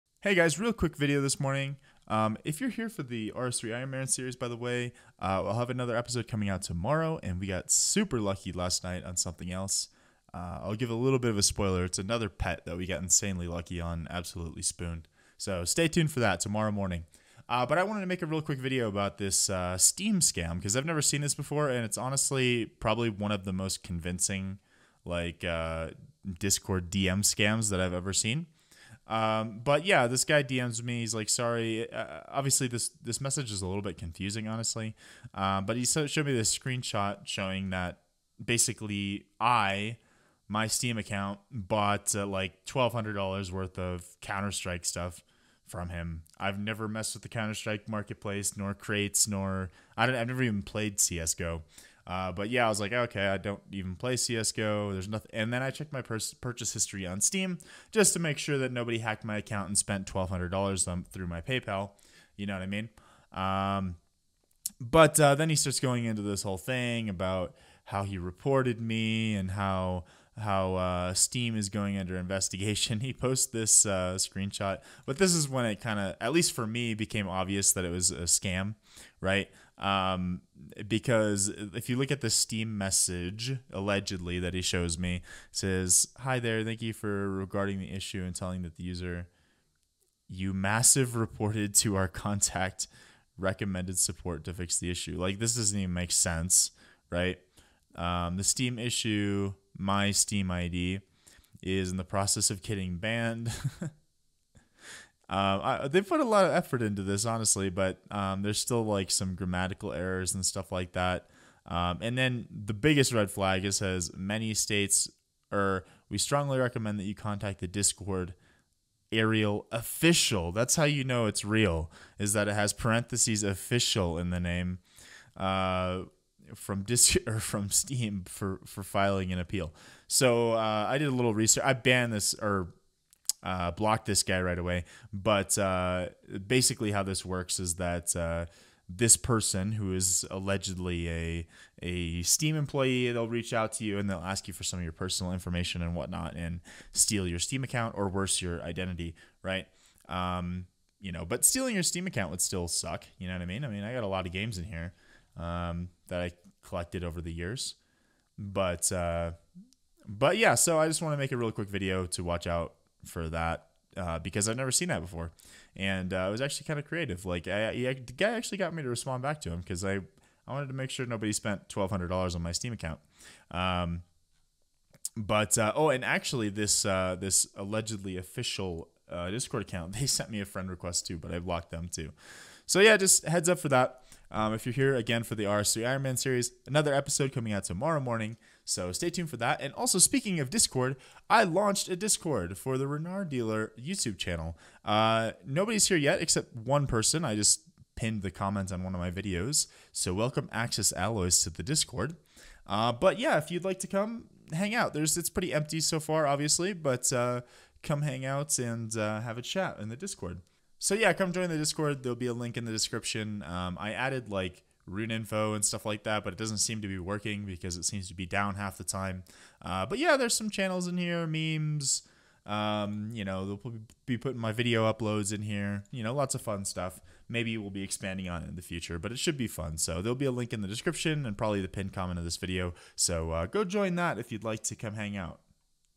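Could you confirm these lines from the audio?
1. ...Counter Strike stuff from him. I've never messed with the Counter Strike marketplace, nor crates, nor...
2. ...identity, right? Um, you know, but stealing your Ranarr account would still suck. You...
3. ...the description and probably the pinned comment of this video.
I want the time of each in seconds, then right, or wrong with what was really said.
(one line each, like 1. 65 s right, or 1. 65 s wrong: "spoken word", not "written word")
1. 44 s right
2. 148 s wrong: "Steam", not "Ranarr"
3. 230 s right.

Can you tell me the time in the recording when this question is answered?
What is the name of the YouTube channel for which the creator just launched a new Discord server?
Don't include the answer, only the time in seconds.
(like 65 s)
192 s.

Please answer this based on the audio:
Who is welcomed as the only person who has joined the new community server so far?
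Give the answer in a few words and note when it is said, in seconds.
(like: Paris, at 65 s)
Axis Alloys, at 200 s.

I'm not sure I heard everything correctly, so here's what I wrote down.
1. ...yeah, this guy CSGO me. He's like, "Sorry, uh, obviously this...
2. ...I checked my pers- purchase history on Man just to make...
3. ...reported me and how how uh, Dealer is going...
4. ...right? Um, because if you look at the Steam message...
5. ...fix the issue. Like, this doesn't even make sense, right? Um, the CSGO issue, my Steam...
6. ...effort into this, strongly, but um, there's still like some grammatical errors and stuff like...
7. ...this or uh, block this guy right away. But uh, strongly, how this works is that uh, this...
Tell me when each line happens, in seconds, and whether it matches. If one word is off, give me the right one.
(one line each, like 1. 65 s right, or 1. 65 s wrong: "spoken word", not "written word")
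1. 29 s wrong: "DMs", not "CSGO"
2. 55 s wrong: "Steam", not "Man"
3. 68 s wrong: "Steam", not "Dealer"
4. 79 s right
5. 94 s wrong: "Steam", not "CSGO"
6. 106 s wrong: "honestly", not "strongly"
7. 132 s wrong: "basically", not "strongly".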